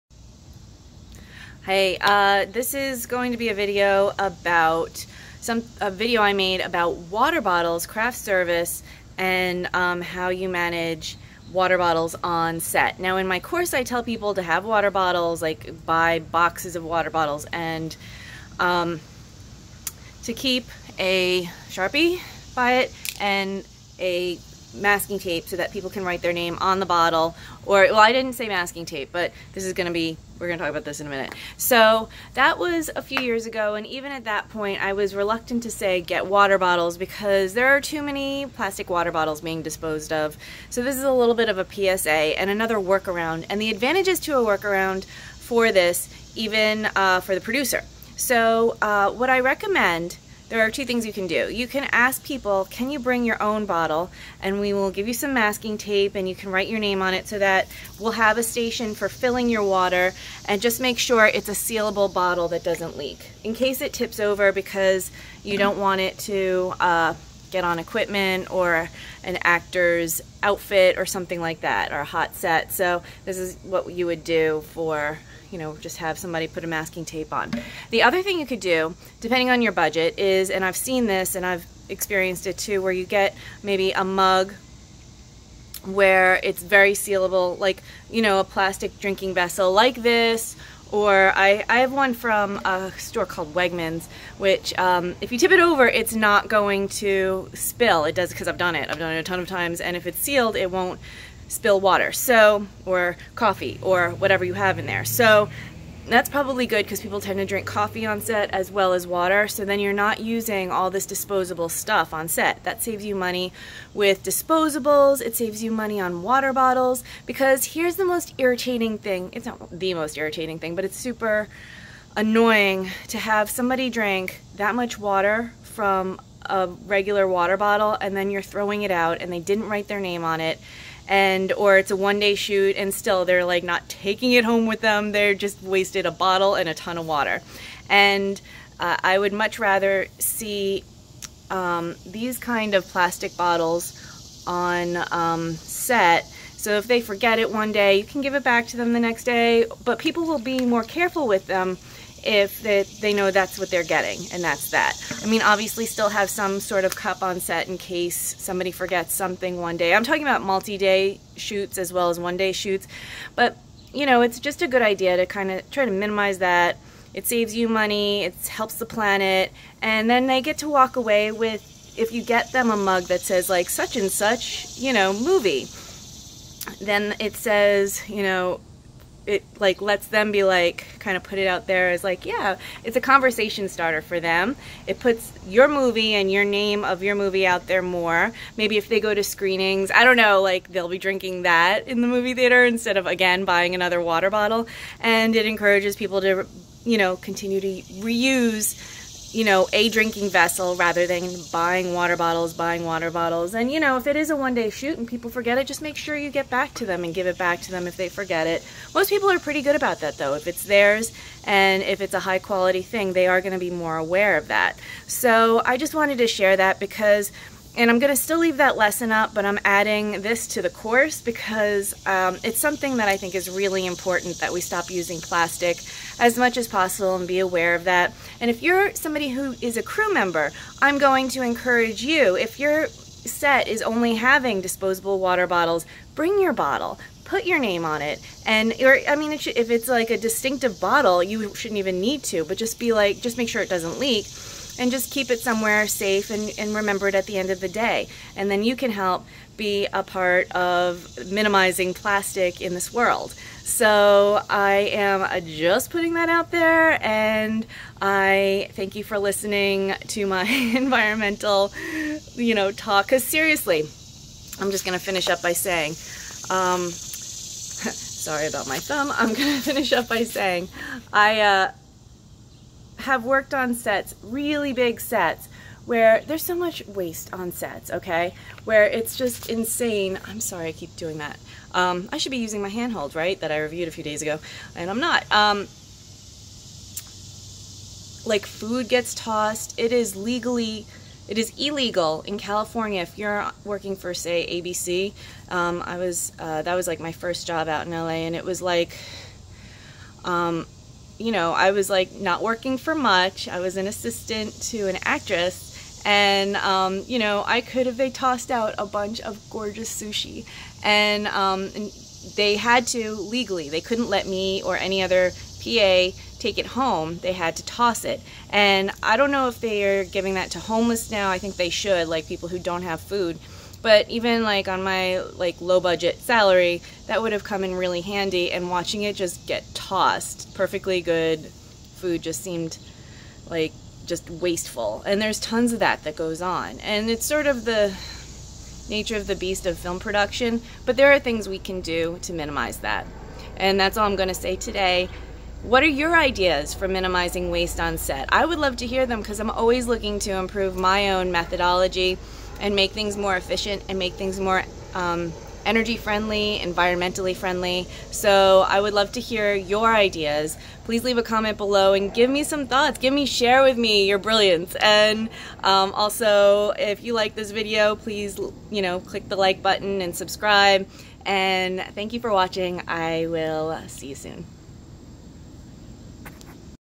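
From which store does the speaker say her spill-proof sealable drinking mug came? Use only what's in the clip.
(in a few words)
Wegmans.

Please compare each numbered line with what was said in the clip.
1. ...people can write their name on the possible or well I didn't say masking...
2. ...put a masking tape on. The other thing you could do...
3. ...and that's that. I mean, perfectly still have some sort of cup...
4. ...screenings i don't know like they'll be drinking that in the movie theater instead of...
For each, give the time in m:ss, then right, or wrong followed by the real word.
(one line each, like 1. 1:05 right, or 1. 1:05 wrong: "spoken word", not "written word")
1. 0:25 wrong: "bottle", not "possible"
2. 1:16 right
3. 2:34 wrong: "obviously", not "perfectly"
4. 3:09 right.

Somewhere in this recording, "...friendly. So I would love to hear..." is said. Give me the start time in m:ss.
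5:57.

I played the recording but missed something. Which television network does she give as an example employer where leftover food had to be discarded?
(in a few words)
ABC.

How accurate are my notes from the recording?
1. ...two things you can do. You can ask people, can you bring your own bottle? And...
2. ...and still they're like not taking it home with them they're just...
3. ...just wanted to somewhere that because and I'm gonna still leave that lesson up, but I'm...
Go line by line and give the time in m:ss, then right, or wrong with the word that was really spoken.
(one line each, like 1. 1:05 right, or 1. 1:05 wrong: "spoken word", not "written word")
1. 0:50 right
2. 2:12 right
3. 3:35 wrong: "share", not "somewhere".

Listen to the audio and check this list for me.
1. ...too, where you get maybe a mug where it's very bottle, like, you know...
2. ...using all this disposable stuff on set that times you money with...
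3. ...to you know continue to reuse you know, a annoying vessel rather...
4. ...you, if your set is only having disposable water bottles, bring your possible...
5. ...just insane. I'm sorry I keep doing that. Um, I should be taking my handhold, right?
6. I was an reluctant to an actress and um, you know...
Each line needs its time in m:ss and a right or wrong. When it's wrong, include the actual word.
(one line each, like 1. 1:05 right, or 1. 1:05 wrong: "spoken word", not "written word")
1. 1:22 wrong: "sealable", not "bottle"
2. 1:50 wrong: "saves", not "times"
3. 3:16 wrong: "drinking", not "annoying"
4. 3:52 wrong: "bottle", not "possible"
5. 4:39 wrong: "using", not "taking"
6. 5:03 wrong: "assistant", not "reluctant".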